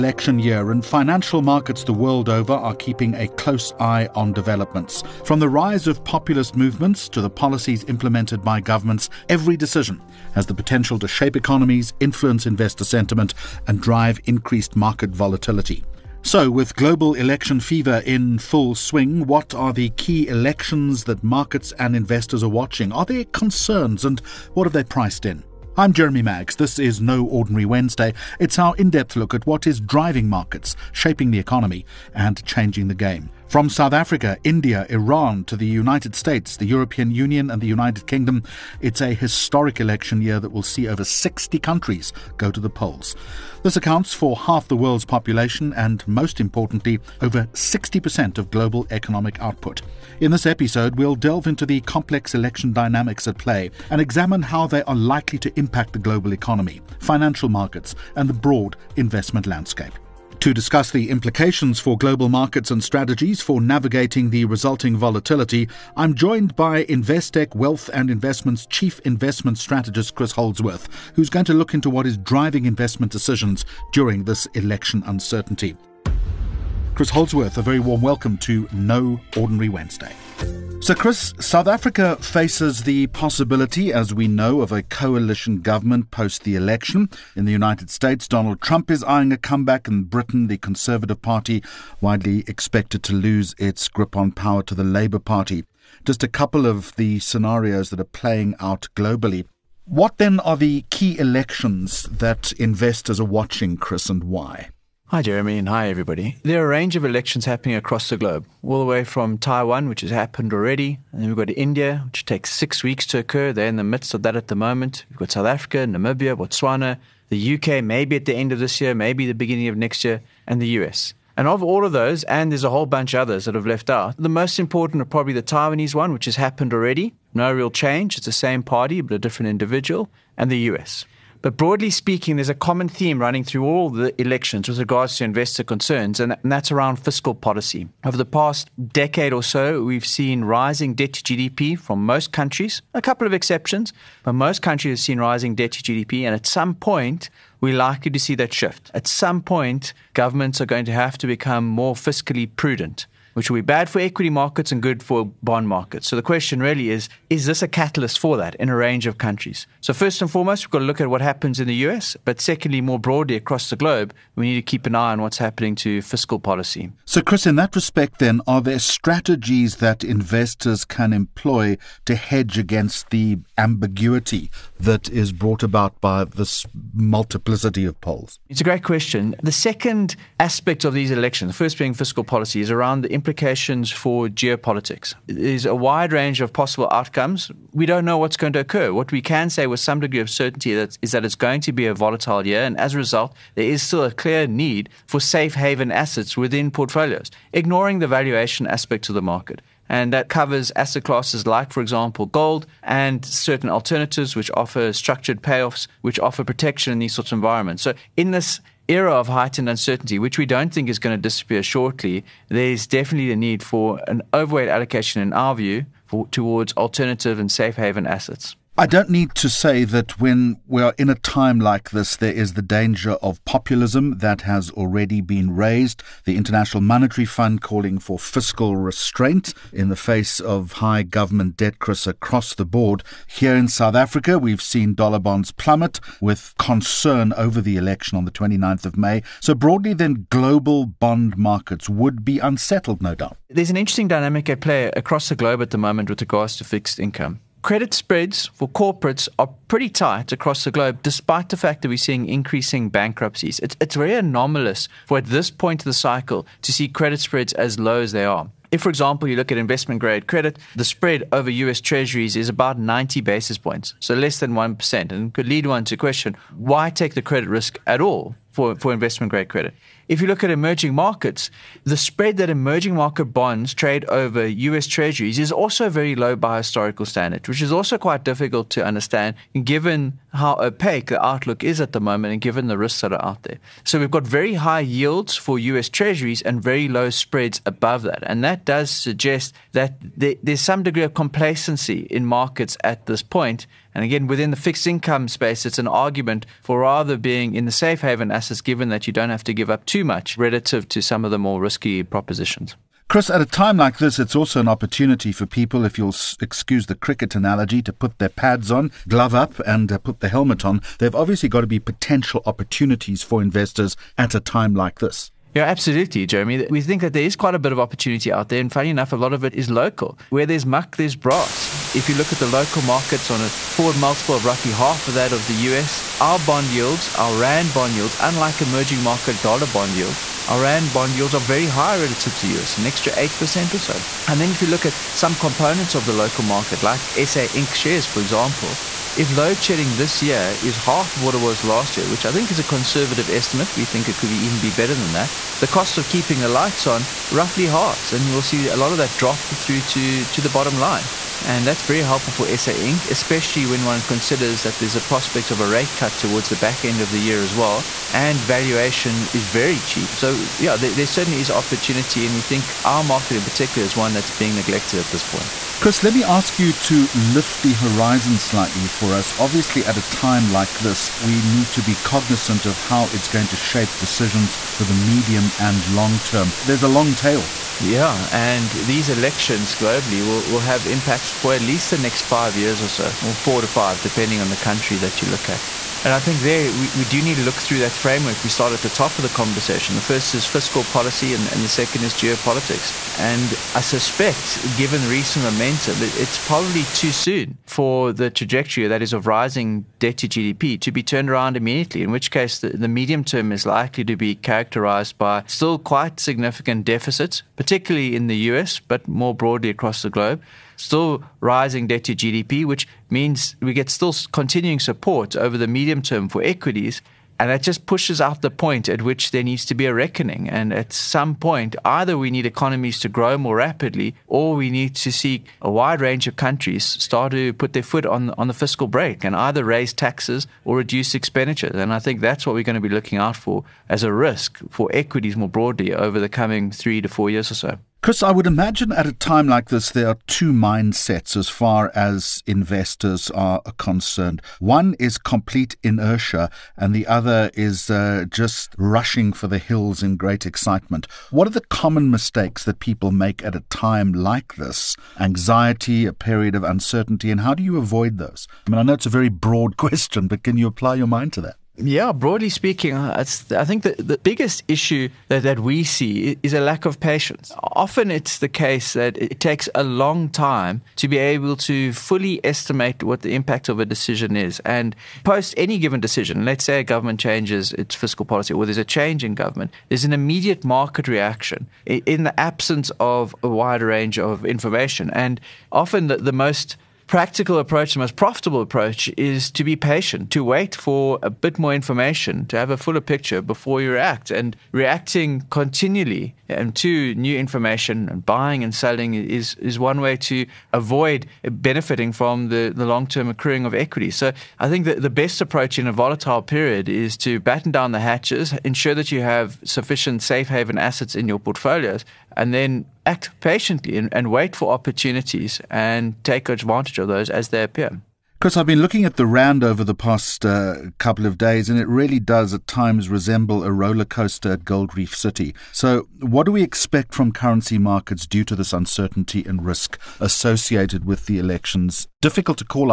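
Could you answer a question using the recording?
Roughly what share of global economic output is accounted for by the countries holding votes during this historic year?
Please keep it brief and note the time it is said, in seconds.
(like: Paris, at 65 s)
over 60%, at 47 s.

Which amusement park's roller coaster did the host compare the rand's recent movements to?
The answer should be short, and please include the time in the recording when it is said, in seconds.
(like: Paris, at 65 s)
Gold Reef City, at 524 s.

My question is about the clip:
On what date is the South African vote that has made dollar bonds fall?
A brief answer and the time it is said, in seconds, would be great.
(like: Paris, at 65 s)
29 May, at 238 s.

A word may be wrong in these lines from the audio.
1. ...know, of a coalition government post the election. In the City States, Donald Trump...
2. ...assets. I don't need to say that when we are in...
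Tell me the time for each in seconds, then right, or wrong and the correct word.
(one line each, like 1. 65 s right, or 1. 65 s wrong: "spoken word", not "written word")
1. 84 s wrong: "United", not "City"
2. 218 s right.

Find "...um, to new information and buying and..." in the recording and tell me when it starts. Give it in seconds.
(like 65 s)
496 s.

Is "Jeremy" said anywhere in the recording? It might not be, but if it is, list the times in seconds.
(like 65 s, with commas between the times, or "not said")
25 s, 105 s, 316 s.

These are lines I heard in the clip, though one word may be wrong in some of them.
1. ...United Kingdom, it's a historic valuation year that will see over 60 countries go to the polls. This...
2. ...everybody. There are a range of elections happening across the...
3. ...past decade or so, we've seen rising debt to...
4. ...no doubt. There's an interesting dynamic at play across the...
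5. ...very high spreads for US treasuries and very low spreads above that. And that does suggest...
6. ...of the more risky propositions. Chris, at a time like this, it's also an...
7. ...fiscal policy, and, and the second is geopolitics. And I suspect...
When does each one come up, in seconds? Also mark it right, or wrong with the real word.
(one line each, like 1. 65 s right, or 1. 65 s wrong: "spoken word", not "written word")
1. 37 s wrong: "election", not "valuation"
2. 105 s right
3. 138 s right
4. 243 s right
5. 284 s wrong: "yields", not "spreads"
6. 301 s right
7. 390 s right.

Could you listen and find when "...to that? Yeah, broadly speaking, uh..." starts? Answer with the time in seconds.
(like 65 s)
461 s.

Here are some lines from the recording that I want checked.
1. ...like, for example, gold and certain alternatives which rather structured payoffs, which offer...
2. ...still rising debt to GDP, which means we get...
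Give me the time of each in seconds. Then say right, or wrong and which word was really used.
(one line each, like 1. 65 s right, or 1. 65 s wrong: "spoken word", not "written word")
1. 201 s wrong: "offer", not "rather"
2. 410 s right.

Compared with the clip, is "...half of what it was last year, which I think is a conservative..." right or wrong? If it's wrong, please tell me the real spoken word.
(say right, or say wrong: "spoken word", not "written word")
right.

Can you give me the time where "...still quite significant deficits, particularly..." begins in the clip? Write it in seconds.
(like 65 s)
405 s.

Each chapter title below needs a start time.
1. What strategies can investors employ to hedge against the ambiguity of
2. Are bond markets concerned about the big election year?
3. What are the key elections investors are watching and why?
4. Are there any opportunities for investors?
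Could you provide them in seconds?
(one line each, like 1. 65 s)
1. 165 s
2. 216 s
3. 80 s
4. 301 s.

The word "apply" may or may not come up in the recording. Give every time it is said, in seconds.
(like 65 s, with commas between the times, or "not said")
460 s.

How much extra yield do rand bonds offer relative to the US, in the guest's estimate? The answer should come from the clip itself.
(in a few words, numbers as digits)
8%.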